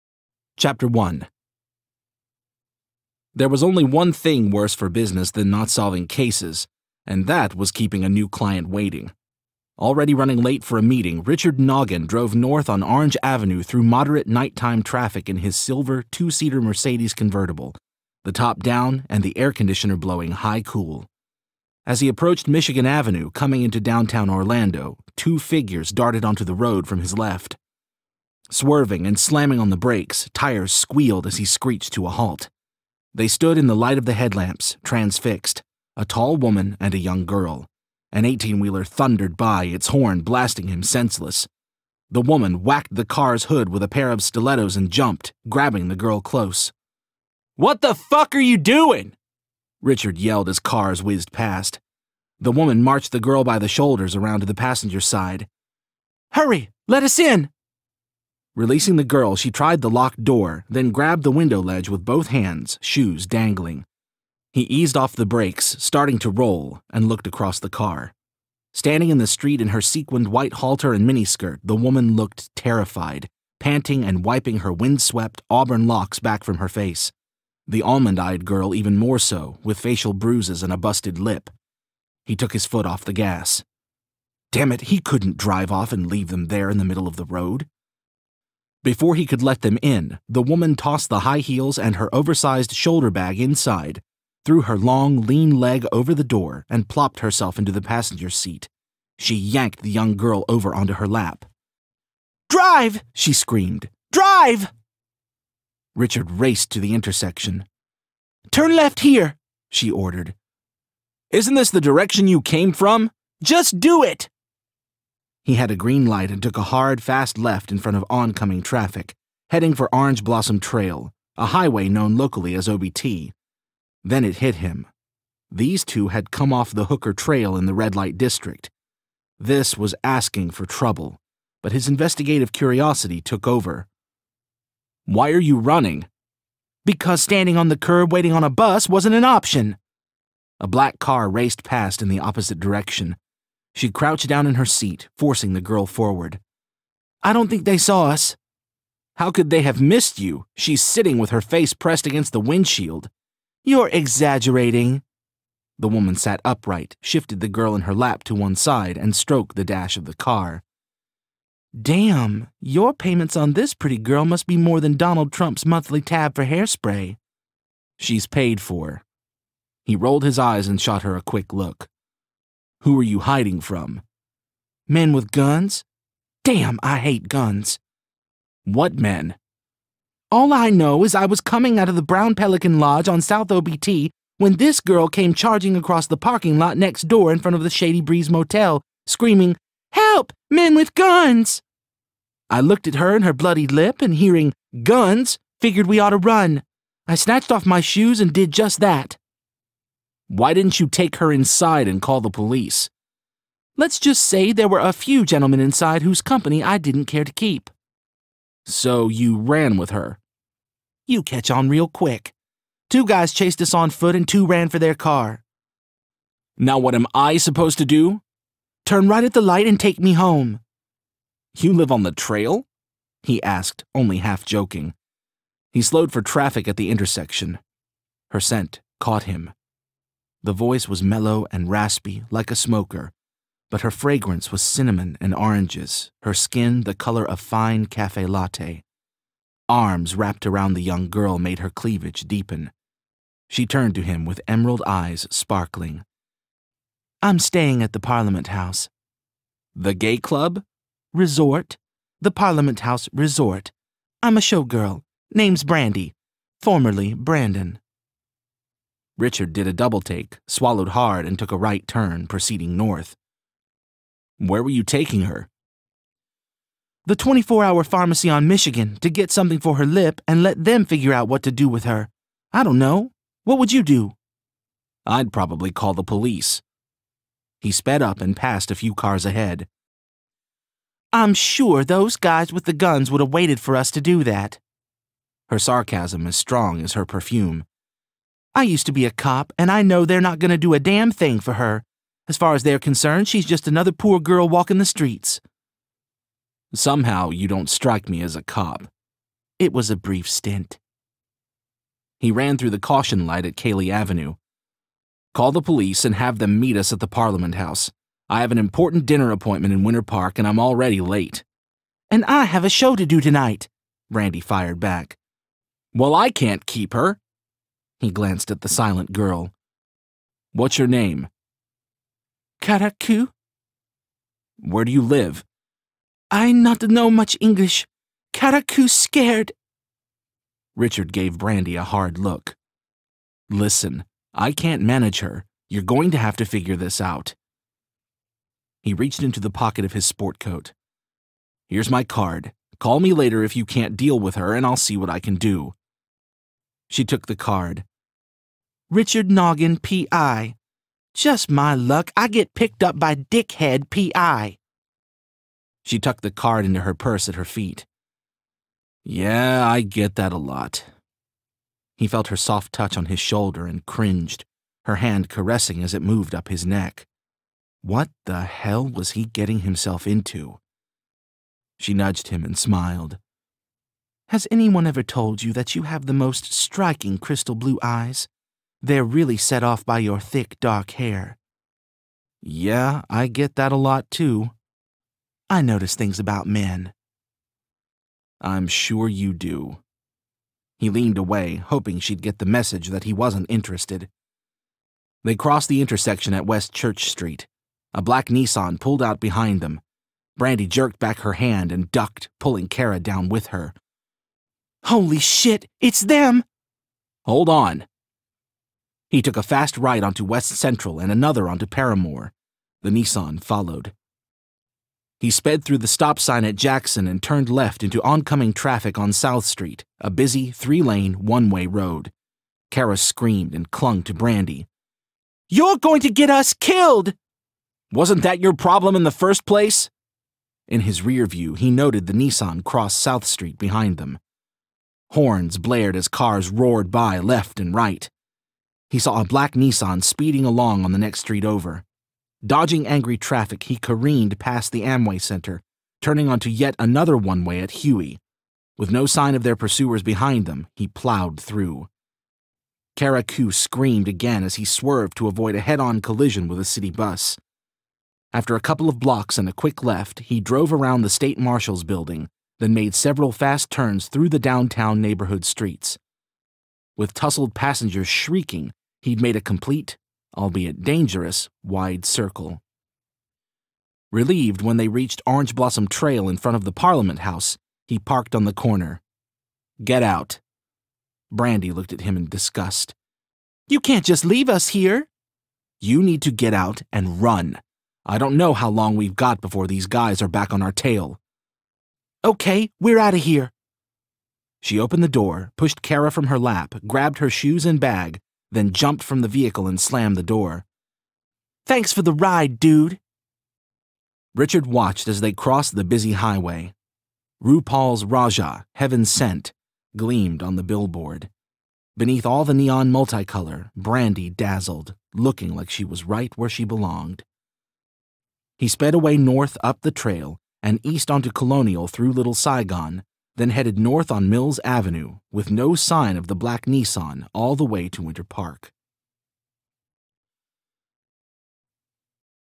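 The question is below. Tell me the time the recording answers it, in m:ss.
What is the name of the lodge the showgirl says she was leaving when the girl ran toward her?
3:02.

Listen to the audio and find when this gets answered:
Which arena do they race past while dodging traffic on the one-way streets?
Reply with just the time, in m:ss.
7:24.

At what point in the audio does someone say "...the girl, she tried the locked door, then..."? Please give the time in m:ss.
0:58.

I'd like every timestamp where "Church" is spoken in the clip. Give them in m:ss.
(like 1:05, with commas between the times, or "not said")
6:36.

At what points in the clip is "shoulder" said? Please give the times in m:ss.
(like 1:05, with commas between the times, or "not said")
0:53, 1:32, 6:03.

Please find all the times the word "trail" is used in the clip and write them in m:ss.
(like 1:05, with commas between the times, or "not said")
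2:00, 2:07, 3:42, 7:55, 8:39.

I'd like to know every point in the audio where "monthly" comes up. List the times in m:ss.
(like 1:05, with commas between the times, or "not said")
2:45.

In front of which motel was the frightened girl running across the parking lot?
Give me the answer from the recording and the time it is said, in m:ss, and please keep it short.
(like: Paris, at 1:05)
Shady Breeze Motel, at 3:07.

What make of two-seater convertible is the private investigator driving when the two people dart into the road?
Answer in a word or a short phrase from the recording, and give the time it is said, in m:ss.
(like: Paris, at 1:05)
Mercedes, at 0:16.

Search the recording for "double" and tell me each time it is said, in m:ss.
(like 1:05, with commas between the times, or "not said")
4:19.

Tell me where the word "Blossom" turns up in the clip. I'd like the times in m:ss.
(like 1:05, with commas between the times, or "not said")
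2:00, 7:55.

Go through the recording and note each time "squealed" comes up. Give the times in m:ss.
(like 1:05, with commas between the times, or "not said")
0:30.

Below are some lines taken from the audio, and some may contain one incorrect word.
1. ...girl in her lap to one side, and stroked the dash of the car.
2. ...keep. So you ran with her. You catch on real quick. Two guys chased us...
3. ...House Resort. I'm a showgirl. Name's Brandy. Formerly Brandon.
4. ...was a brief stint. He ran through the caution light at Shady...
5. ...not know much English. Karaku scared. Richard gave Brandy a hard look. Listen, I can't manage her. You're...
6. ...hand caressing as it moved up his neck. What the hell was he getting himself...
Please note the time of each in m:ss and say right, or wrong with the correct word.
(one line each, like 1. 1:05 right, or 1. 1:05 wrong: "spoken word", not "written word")
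1. 2:37 right
2. 3:27 right
3. 4:12 right
4. 4:59 wrong: "Kaley", not "Shady"
5. 5:26 right
6. 6:04 right.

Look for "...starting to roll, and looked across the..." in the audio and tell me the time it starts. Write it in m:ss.
1:05.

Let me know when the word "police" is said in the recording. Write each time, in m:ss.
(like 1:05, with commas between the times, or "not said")
3:22, 4:36, 5:05.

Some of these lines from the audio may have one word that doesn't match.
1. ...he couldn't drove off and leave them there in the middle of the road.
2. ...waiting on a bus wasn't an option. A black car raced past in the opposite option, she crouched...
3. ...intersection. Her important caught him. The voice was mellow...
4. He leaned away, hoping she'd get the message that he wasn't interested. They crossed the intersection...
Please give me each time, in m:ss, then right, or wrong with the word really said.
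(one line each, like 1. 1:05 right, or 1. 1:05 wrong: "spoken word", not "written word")
1. 1:24 wrong: "drive", not "drove"
2. 2:18 wrong: "direction", not "option"
3. 3:46 wrong: "scent", not "important"
4. 6:30 right.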